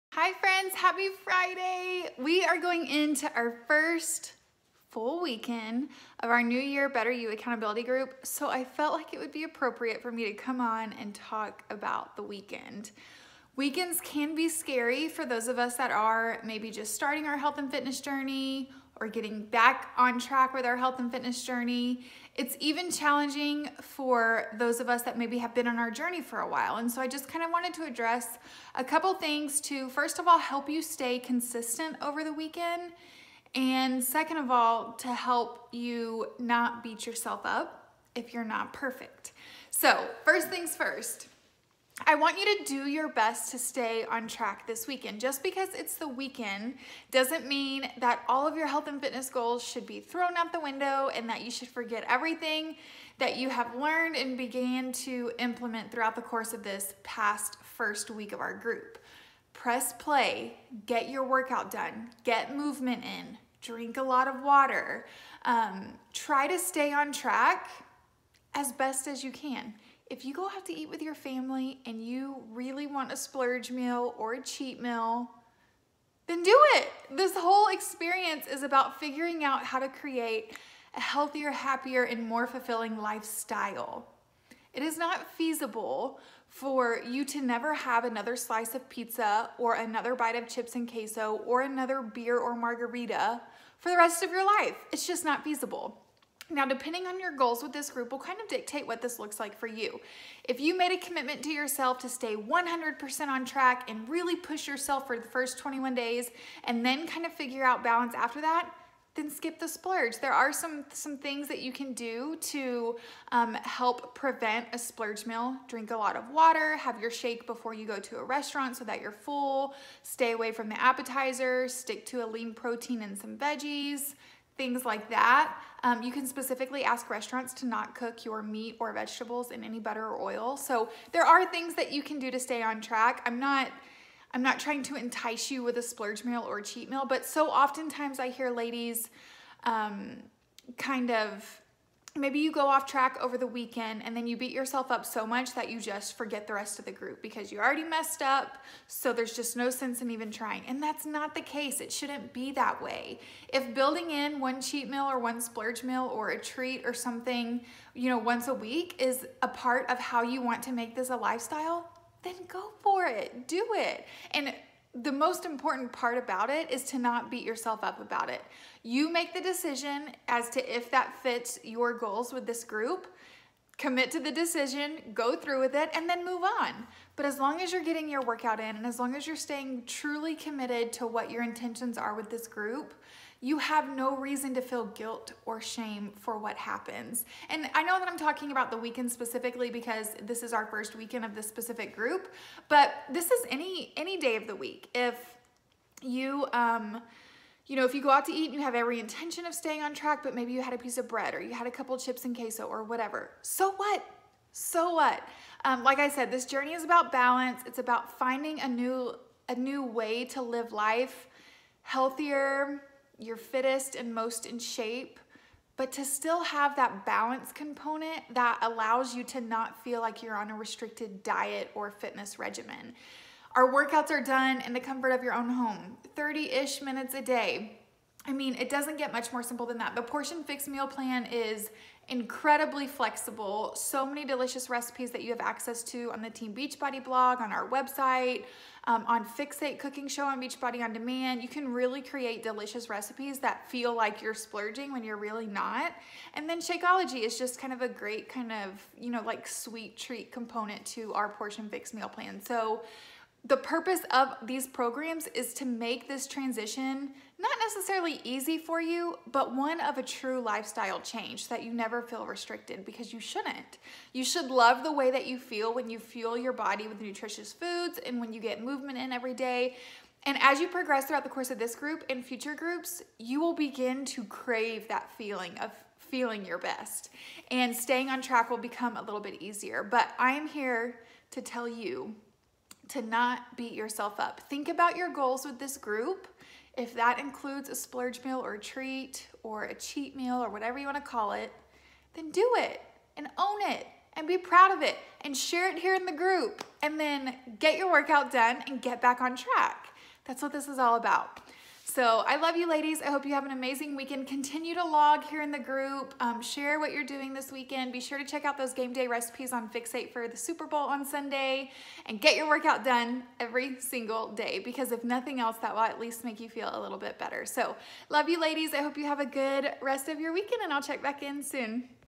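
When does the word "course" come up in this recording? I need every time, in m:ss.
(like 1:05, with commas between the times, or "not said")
0:56, 4:31.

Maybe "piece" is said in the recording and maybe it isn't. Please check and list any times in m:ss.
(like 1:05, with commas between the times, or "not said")
3:20.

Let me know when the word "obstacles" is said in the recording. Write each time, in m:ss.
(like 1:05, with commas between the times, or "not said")
not said.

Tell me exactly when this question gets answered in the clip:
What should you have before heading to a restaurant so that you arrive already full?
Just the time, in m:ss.
1:57.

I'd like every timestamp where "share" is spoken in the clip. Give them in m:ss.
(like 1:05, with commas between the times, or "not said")
4:55, 5:06.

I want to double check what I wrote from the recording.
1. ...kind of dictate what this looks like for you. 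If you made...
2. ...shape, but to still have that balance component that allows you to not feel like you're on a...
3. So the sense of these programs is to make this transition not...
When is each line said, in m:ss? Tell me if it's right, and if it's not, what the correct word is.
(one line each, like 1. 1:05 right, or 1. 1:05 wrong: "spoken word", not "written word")
1. 1:38 right
2. 3:34 right
3. 4:12 wrong: "purpose", not "sense".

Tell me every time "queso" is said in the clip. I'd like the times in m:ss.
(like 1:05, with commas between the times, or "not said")
1:30, 3:22.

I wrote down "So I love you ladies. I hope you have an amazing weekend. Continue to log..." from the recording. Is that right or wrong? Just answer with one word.
right.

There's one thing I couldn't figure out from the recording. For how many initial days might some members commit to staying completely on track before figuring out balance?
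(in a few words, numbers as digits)
21.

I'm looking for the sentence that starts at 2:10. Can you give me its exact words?
So there are things that you can do to stay on track.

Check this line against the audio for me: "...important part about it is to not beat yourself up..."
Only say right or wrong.
right.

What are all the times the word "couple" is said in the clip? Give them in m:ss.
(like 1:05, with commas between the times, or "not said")
0:28, 3:21.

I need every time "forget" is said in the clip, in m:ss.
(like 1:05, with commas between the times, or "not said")
0:51, 2:26.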